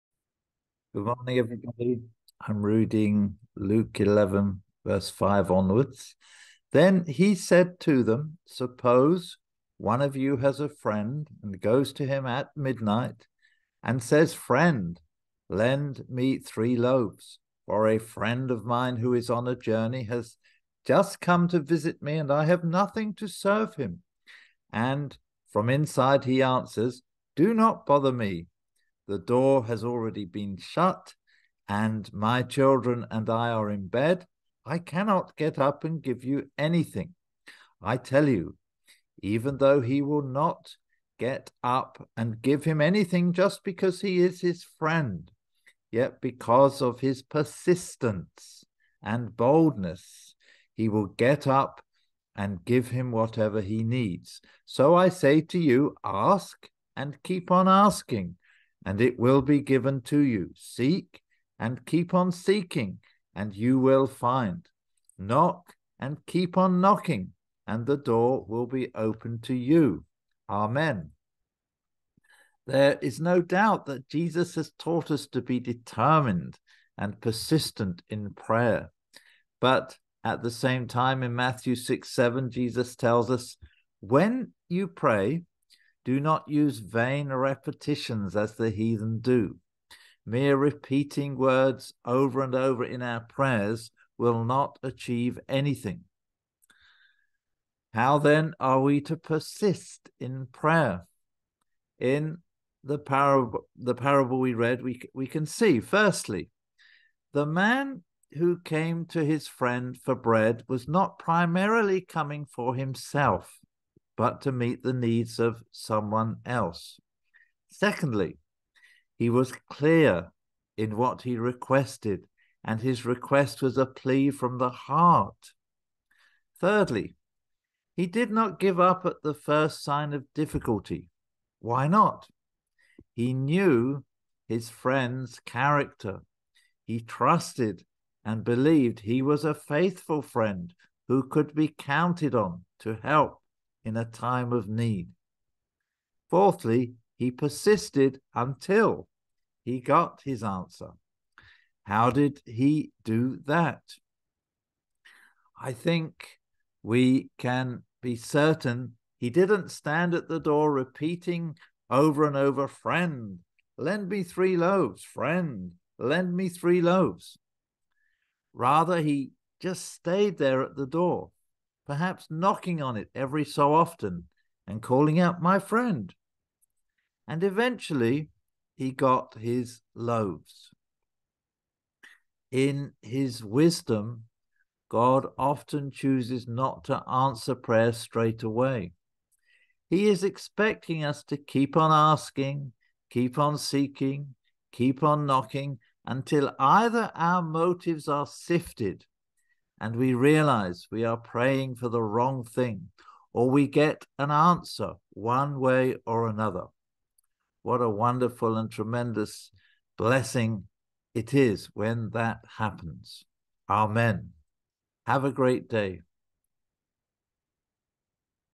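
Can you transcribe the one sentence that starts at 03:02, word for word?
In his wisdom, God often chooses not to answer prayer straight away.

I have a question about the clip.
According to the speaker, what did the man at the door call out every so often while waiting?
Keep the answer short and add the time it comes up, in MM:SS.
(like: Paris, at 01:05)
My friend, at 02:55.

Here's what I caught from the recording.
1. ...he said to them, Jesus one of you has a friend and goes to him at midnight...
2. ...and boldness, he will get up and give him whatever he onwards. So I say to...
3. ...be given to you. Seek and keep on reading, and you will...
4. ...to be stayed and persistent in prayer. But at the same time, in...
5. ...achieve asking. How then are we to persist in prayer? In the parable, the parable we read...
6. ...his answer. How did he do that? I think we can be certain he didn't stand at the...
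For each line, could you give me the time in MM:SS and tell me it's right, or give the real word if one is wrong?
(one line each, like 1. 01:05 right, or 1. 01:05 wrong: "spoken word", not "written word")
1. 00:07 wrong: "Suppose", not "Jesus"
2. 00:49 wrong: "needs", not "onwards"
3. 00:59 wrong: "seeking", not "reading"
4. 01:15 wrong: "determined", not "stayed"
5. 01:34 wrong: "anything", not "asking"
6. 02:30 right.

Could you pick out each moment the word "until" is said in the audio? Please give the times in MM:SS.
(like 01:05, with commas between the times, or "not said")
02:28, 03:16.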